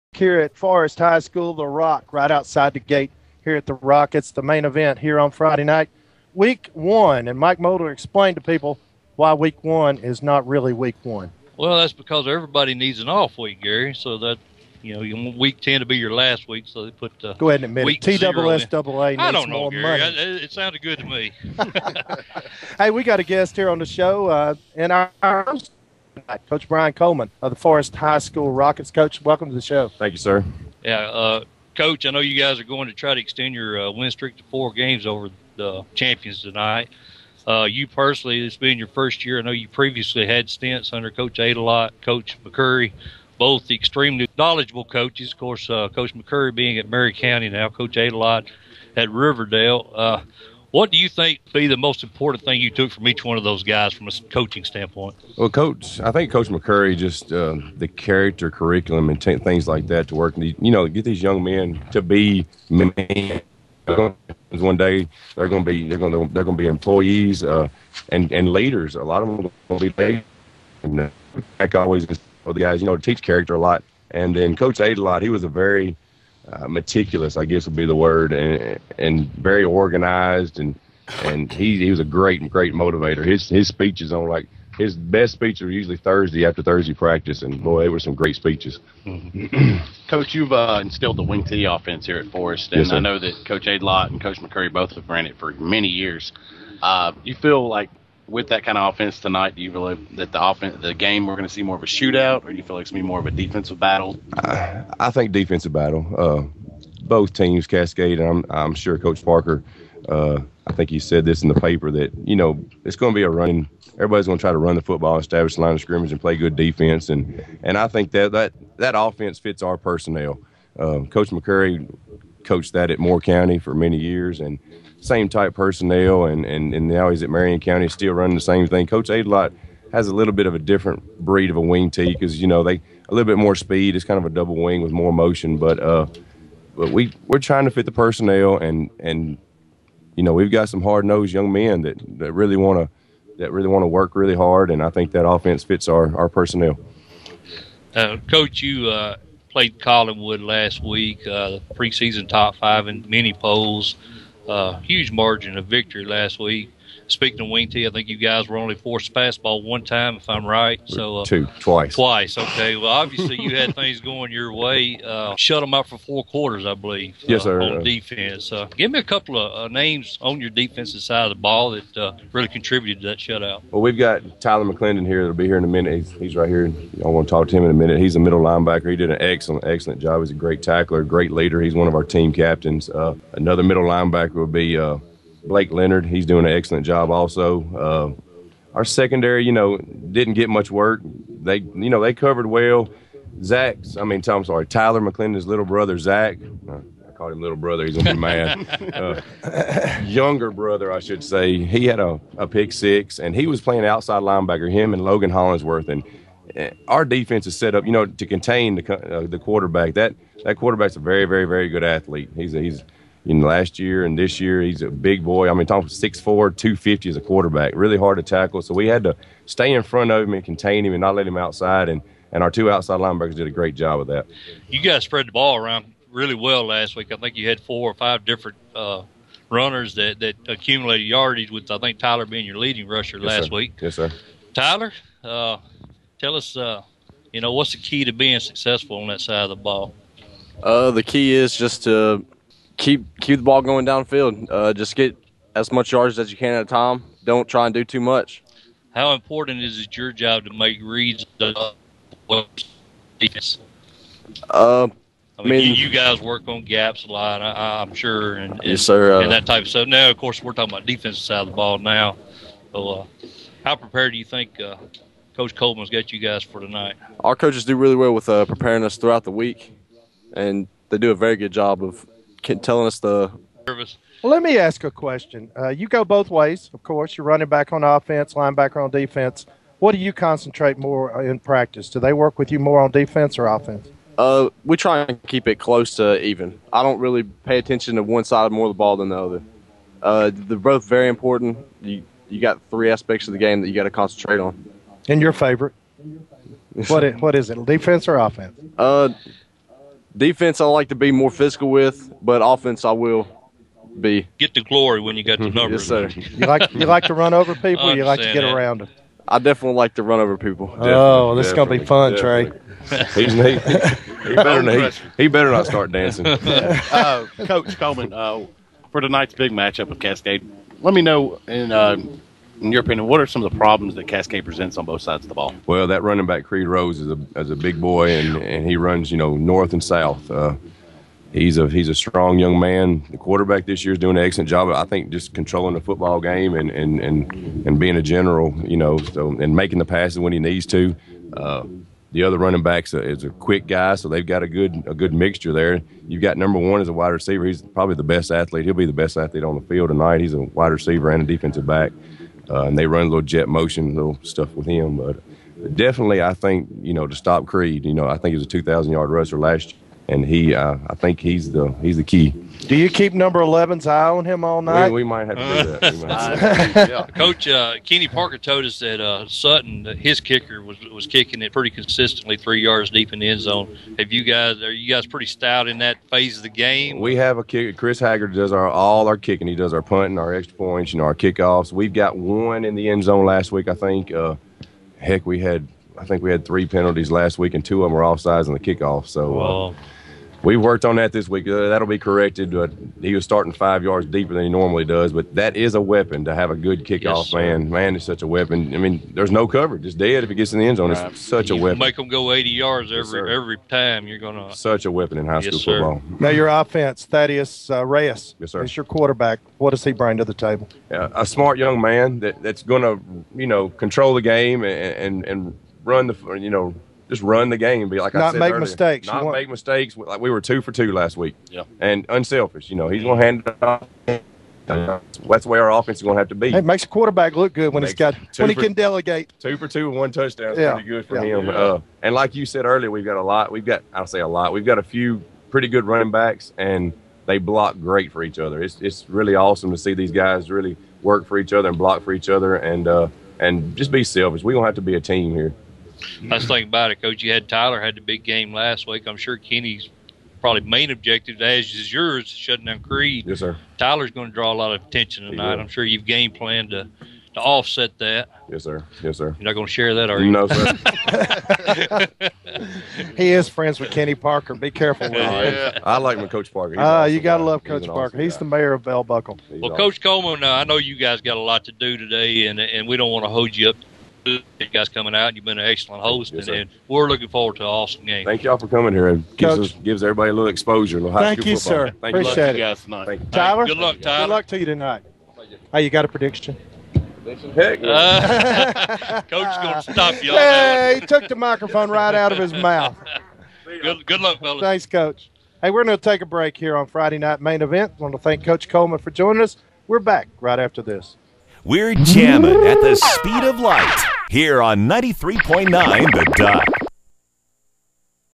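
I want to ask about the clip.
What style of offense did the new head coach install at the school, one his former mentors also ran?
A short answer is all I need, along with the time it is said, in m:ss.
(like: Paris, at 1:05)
Wing T, at 1:31.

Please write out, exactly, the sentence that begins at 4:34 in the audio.
Well, let me ask a question.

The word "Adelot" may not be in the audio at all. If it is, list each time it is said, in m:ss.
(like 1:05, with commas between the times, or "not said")
0:41, 0:47, 2:09.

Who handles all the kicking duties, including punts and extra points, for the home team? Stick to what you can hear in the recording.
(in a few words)
Chris Haggard.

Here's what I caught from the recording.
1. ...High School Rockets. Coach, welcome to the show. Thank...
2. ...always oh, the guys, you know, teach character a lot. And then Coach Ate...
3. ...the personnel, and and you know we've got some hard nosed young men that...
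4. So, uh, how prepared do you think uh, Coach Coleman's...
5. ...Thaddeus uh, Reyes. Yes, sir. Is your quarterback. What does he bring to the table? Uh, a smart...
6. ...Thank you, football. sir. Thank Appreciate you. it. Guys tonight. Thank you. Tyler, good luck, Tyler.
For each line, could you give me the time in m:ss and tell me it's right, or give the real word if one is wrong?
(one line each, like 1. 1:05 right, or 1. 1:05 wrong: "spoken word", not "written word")
1. 0:27 right
2. 1:11 right
3. 2:17 right
4. 4:22 right
5. 6:47 right
6. 8:01 right.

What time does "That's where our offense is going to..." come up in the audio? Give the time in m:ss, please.
7:05.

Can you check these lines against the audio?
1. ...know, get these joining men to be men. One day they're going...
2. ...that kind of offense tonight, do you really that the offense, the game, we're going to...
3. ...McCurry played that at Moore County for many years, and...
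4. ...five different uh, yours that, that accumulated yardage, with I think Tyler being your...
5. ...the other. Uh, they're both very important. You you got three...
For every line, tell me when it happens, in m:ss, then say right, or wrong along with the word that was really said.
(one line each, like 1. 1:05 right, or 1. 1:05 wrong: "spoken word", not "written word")
1. 1:00 wrong: "young", not "joining"
2. 1:38 right
3. 2:01 wrong: "coached", not "played"
4. 3:47 wrong: "runners", not "yours"
5. 4:49 right.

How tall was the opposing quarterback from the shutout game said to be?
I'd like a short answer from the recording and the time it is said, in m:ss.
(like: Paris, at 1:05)
6'4", at 3:35.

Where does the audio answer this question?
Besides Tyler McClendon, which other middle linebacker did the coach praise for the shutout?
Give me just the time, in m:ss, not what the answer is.
3:05.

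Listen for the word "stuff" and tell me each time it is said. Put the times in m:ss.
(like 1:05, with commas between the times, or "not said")
4:19, 5:54.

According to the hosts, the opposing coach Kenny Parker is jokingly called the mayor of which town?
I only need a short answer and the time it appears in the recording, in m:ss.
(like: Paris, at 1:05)
Bell Buckle, at 7:48.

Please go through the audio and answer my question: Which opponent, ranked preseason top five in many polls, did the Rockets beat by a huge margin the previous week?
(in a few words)
Collinwood.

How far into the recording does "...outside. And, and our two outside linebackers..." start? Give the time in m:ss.
3:41.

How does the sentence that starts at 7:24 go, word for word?
We're gonna have to be a team here.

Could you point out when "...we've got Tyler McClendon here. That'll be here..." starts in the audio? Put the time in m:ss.
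2:53.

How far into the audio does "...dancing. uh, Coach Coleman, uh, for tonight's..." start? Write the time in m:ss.
5:15.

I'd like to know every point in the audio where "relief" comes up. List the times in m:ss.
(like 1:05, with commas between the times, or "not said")
not said.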